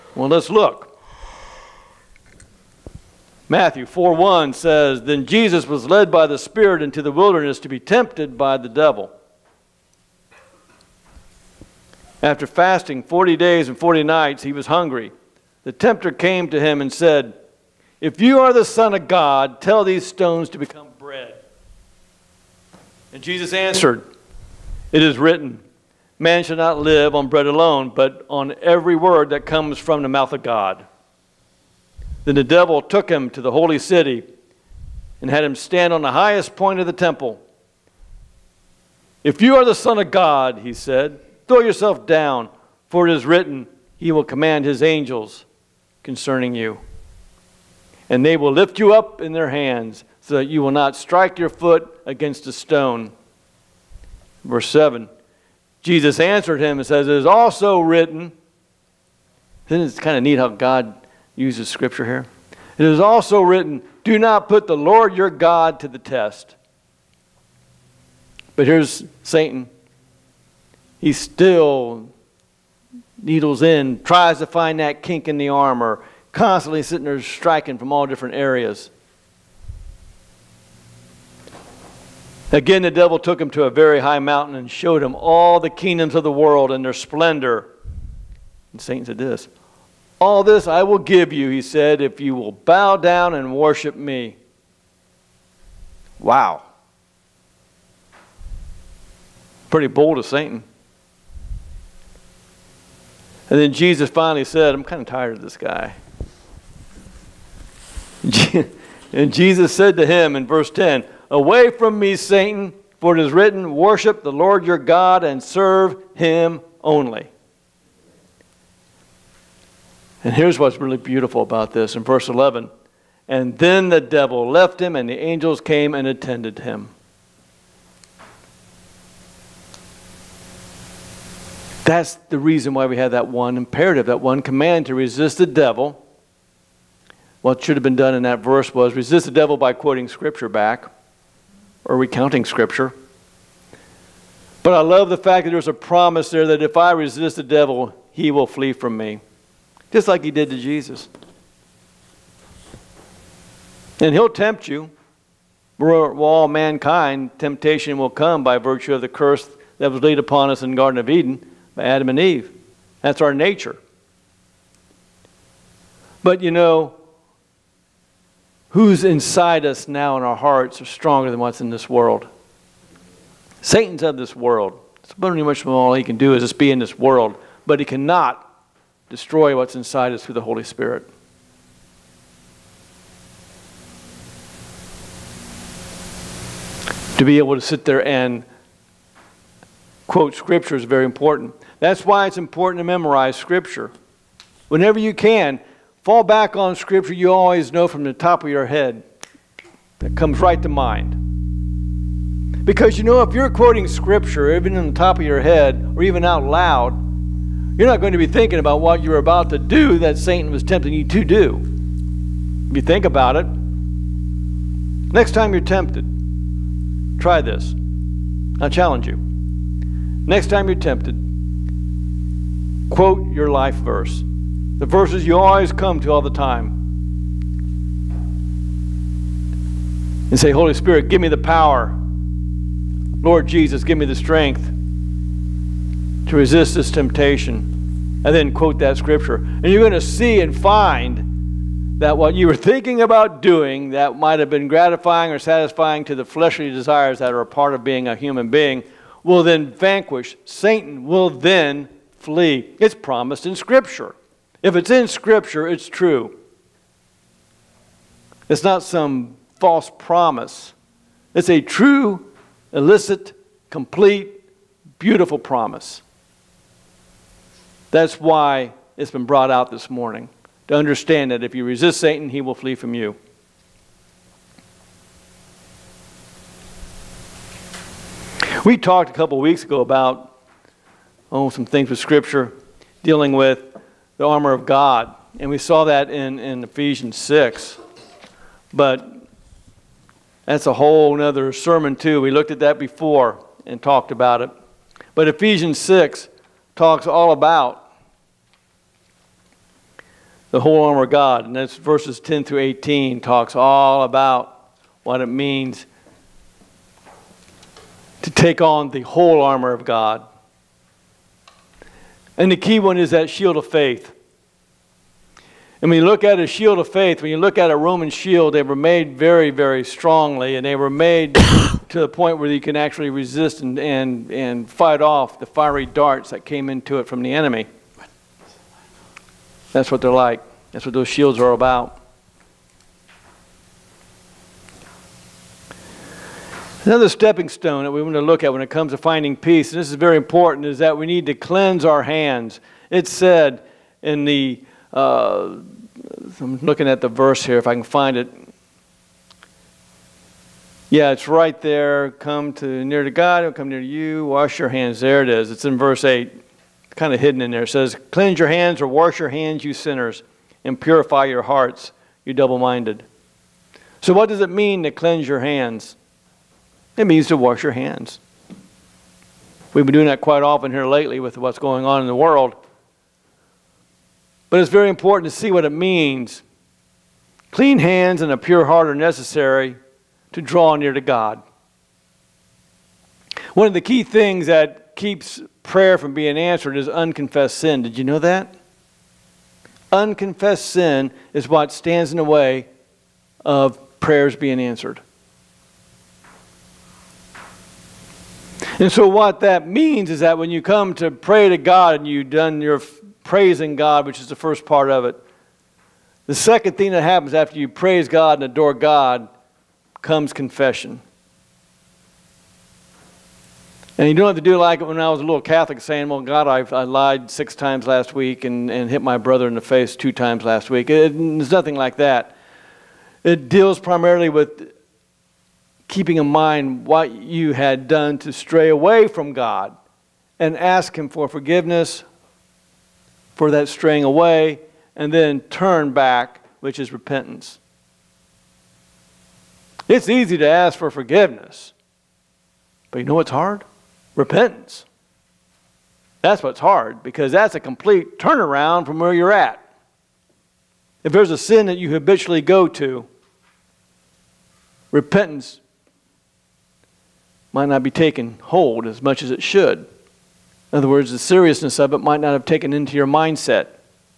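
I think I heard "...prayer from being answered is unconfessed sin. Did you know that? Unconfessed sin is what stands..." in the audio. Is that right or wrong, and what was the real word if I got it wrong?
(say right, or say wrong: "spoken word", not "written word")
right.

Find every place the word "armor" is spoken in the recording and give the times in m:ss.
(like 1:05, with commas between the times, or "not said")
1:15, 4:44, 5:00, 5:09.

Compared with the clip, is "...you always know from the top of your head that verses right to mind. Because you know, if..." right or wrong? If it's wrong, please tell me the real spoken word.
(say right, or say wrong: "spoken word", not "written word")
wrong: "comes", not "verses".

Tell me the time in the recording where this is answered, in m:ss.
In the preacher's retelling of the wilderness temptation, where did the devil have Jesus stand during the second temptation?
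0:36.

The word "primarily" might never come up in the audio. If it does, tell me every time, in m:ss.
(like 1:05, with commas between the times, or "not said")
7:03.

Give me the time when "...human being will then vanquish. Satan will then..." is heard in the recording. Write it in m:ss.
4:08.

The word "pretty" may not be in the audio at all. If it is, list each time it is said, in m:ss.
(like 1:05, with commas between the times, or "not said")
1:39, 2:55.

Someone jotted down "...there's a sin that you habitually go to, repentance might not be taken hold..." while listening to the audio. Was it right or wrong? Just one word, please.
right.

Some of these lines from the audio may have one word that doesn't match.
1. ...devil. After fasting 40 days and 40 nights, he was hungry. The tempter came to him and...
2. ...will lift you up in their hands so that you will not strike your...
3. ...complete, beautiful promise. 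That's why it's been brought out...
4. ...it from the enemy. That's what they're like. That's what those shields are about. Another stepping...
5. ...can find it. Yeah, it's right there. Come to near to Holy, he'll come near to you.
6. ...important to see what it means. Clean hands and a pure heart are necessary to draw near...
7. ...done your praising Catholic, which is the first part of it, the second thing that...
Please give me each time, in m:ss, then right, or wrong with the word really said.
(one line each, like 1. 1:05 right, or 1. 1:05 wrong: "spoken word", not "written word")
1. 0:08 right
2. 0:48 right
3. 4:23 right
4. 5:26 right
5. 5:47 wrong: "God", not "Holy"
6. 6:14 right
7. 6:42 wrong: "God", not "Catholic".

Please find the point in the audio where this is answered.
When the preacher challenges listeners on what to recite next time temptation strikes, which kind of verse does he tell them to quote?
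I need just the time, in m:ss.
3:43.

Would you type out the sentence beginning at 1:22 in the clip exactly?
Again, the devil took him to a very high mountain and showed him all the kingdoms of the world and their splendor.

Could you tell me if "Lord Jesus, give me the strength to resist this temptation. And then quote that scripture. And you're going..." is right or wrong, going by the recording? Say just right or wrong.
right.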